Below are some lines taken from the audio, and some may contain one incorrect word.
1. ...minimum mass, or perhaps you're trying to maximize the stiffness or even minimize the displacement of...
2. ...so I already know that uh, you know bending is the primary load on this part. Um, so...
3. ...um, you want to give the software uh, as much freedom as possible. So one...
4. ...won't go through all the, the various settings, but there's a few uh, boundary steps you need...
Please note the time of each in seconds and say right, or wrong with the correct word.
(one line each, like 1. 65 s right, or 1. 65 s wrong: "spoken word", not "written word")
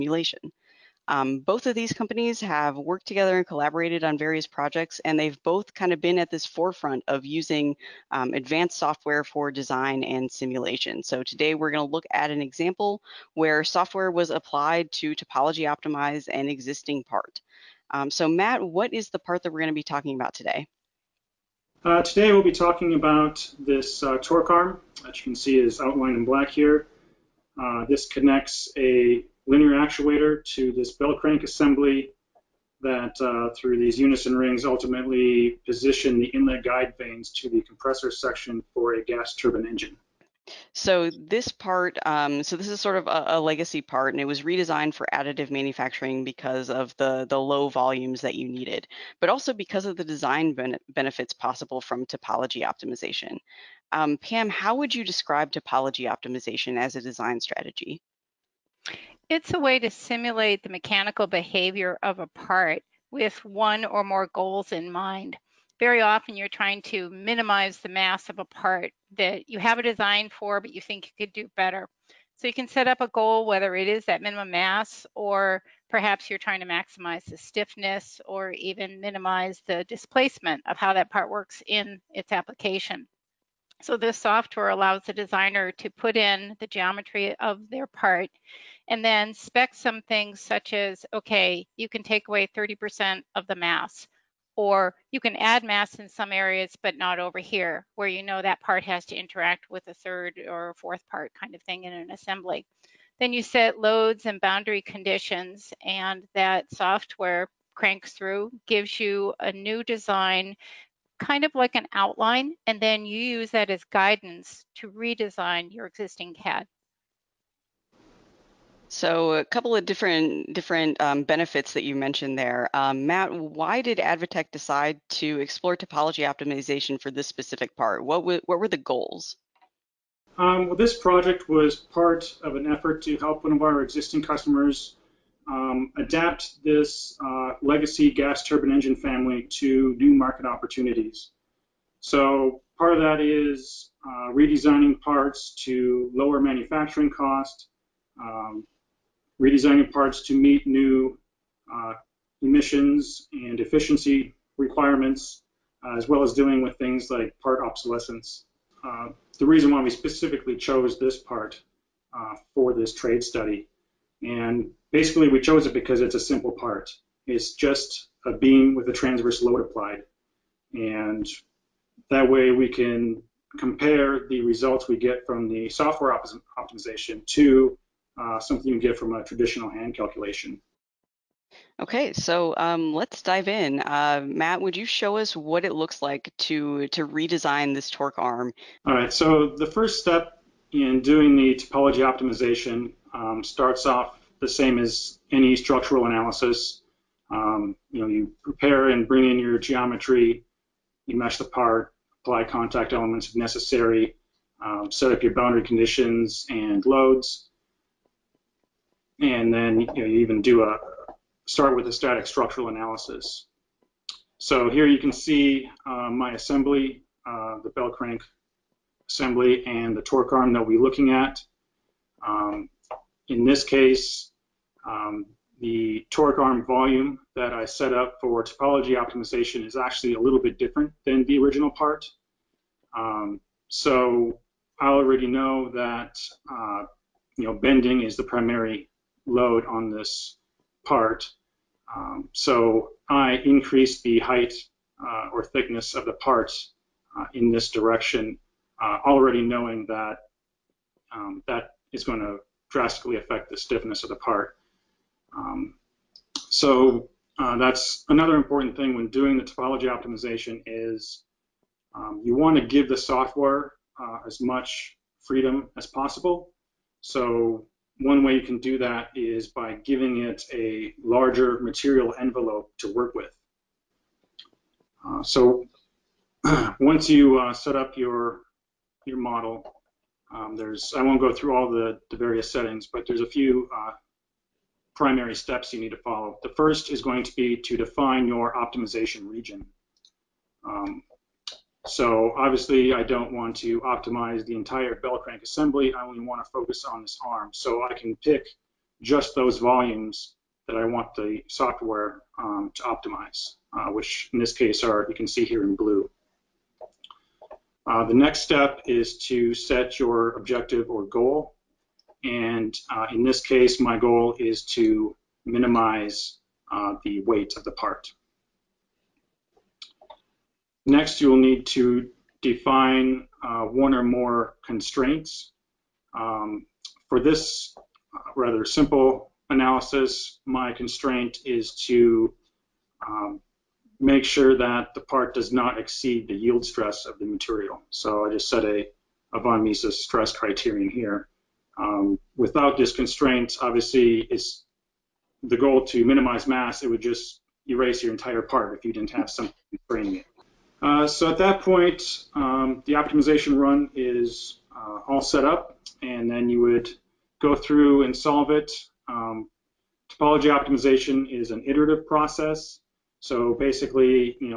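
1. 74 s right
2. 233 s right
3. 261 s right
4. 281 s wrong: "primary", not "boundary".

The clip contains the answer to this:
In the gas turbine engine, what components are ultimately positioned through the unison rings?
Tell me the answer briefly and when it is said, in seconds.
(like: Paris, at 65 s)
Inlet guide vanes, at 36 s.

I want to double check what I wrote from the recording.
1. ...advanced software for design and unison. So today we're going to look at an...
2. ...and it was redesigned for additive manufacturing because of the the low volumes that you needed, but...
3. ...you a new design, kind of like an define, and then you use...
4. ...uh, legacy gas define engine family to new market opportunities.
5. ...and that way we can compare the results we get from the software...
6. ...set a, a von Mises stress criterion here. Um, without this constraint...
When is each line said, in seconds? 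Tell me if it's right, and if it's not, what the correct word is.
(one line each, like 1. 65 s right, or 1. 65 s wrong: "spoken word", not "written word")
1. 8 s wrong: "simulation", not "unison"
2. 44 s right
3. 108 s wrong: "outline", not "define"
4. 137 s wrong: "turbine", not "define"
5. 170 s right
6. 338 s right.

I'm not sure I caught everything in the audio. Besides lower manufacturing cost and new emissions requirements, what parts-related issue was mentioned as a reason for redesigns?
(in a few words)
Part obsolescence.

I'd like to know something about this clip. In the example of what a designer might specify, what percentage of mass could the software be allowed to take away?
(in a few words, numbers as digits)
30%.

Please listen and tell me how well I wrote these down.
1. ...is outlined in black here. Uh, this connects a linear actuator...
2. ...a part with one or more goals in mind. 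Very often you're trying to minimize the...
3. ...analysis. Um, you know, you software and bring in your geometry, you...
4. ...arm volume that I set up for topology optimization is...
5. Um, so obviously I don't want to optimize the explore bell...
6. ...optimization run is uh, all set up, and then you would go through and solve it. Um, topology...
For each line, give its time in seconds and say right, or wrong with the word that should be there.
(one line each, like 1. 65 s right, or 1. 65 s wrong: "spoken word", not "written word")
1. 25 s right
2. 62 s right
3. 196 s wrong: "prepare", not "software"
4. 226 s right
5. 290 s wrong: "entire", not "explore"
6. 352 s right.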